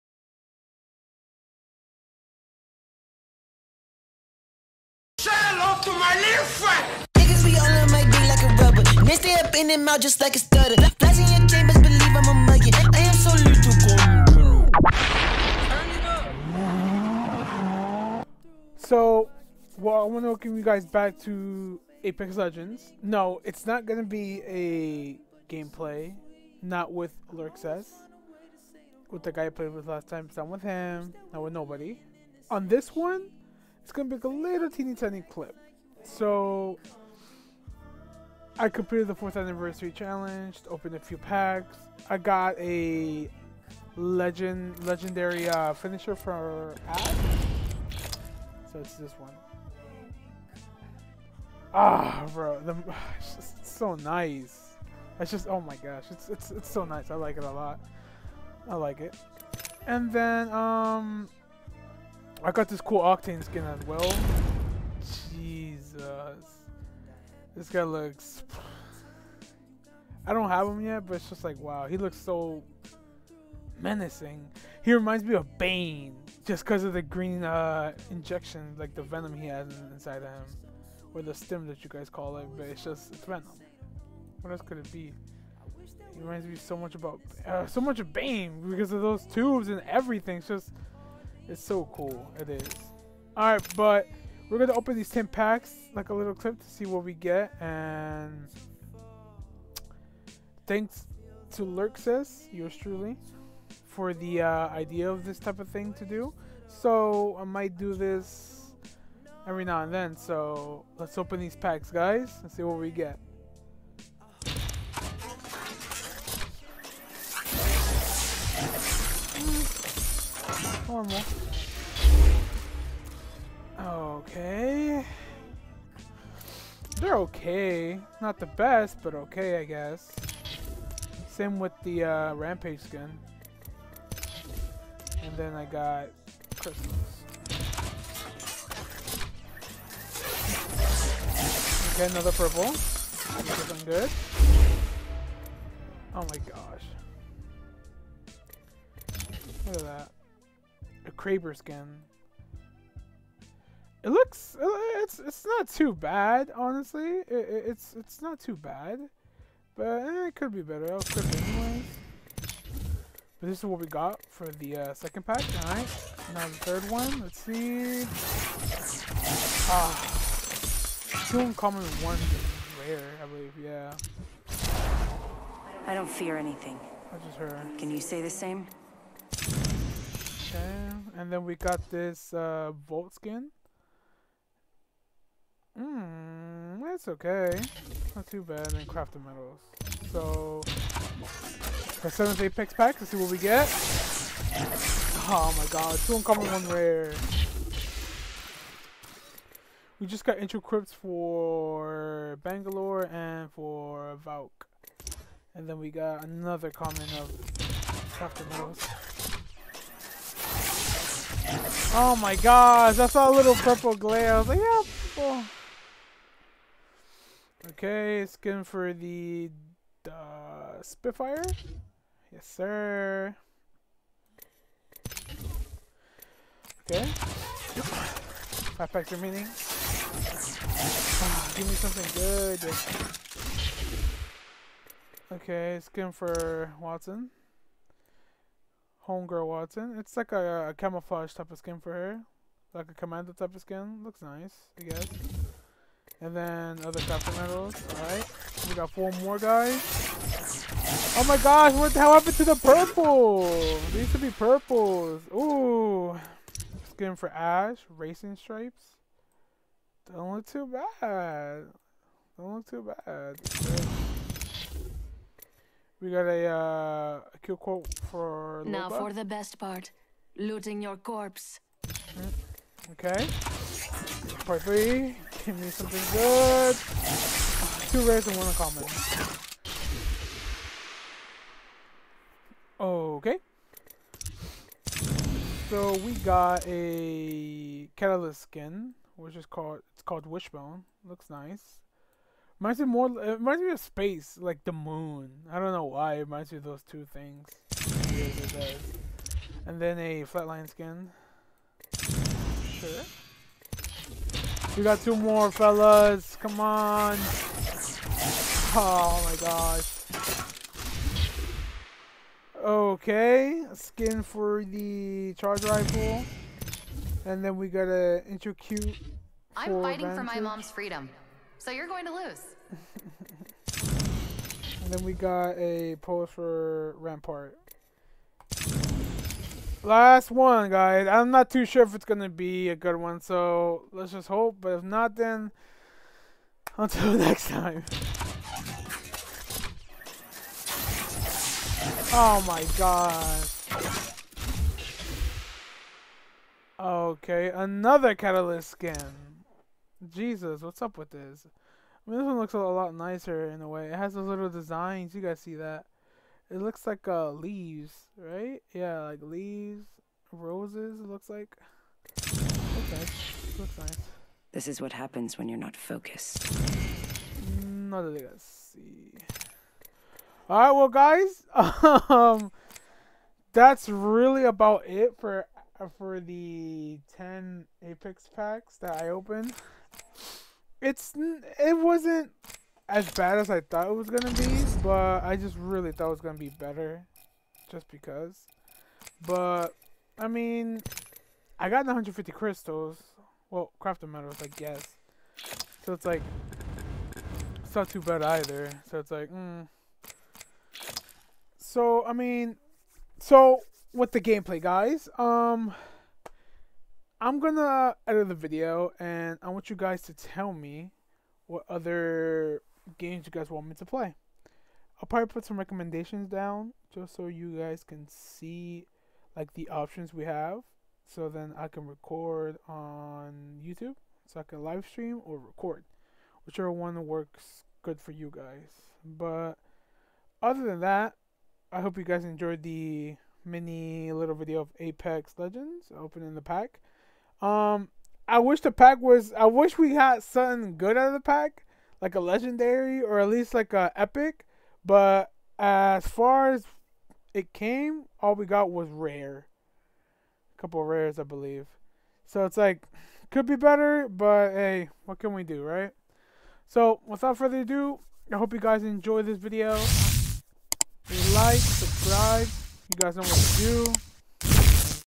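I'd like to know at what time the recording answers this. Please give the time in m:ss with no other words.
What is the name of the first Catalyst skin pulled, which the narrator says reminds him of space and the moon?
4:50.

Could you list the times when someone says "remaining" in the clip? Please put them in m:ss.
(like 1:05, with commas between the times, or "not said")
3:49.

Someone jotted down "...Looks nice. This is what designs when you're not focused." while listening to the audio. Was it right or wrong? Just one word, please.
wrong.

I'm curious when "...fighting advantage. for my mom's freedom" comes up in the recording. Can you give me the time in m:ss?
5:19.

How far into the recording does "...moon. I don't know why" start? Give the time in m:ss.
4:54.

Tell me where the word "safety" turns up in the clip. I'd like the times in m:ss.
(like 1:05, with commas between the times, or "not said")
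not said.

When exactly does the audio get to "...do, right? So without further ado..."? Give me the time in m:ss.
7:35.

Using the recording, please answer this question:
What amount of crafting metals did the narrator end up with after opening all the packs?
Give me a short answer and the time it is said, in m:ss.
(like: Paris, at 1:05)
150, at 6:31.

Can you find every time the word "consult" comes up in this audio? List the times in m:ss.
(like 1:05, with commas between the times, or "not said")
not said.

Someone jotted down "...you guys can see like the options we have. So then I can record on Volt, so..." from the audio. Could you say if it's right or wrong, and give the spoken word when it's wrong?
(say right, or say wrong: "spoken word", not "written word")
wrong: "YouTube", not "Volt".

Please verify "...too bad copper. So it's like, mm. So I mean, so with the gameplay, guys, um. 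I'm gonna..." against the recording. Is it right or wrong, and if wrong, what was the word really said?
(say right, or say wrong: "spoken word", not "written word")
wrong: "either", not "copper".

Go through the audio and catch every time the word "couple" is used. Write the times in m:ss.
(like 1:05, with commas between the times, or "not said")
7:30.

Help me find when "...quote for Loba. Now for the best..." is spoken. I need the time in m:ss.
4:27.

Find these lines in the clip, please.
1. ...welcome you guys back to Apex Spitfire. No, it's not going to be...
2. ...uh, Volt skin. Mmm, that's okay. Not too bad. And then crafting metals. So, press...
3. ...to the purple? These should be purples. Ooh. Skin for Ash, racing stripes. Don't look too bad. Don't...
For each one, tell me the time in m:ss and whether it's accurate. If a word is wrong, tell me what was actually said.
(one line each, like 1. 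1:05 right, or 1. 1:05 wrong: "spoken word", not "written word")
1. 0:20 wrong: "Legends", not "Spitfire"
2. 3:02 right
3. 4:12 right.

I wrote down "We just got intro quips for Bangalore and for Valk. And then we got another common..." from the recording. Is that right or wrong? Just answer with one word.
right.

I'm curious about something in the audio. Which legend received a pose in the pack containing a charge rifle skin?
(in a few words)
Rampart.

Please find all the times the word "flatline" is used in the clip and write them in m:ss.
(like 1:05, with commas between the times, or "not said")
5:00.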